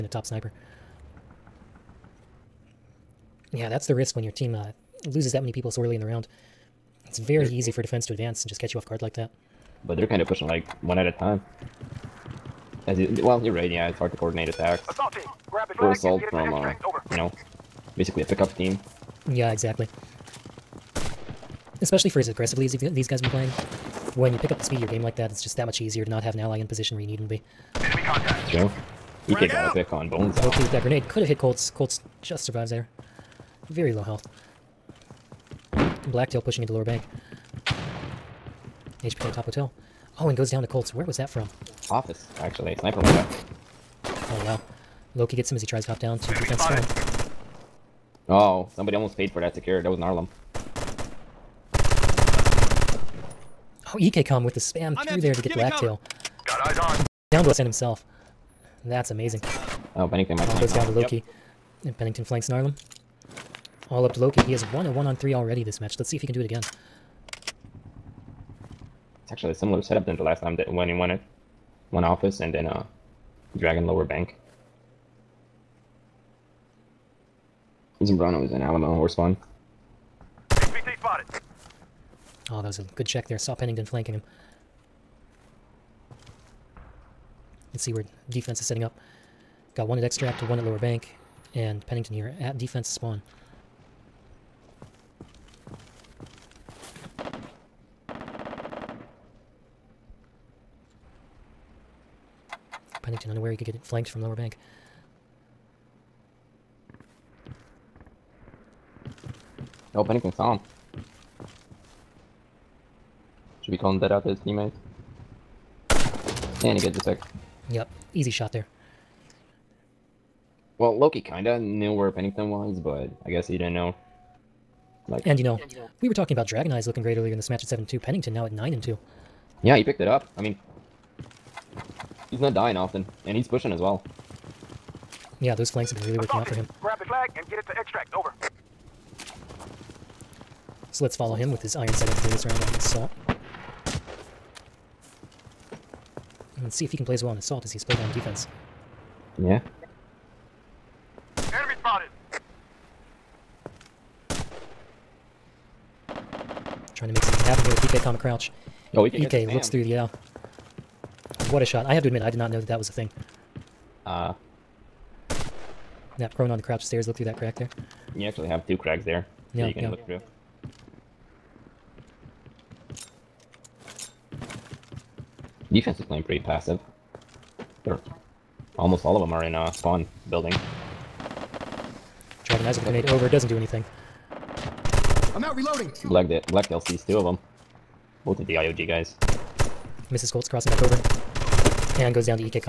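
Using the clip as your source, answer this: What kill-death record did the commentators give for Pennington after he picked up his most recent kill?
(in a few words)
9 and 2.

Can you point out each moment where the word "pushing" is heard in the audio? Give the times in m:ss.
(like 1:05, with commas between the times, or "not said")
0:10, 0:36, 2:13.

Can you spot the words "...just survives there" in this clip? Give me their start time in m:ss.
0:32.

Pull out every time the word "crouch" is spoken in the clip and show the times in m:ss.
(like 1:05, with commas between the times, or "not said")
2:38, 2:46.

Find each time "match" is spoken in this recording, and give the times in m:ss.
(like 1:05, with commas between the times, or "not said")
1:05, 2:07.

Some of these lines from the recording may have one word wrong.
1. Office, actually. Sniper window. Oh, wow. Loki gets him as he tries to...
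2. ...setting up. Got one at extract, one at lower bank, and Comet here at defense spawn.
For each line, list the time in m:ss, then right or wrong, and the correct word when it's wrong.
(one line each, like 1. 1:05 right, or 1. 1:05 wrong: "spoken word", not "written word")
1. 0:41 right
2. 1:28 wrong: "Pennington", not "Comet".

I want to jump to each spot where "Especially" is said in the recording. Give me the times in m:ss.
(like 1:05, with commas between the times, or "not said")
0:21.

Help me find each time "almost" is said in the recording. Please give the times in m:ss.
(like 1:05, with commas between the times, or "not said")
0:48, 2:58.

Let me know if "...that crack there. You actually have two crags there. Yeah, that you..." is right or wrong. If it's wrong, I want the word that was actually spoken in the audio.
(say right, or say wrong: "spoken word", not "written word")
right.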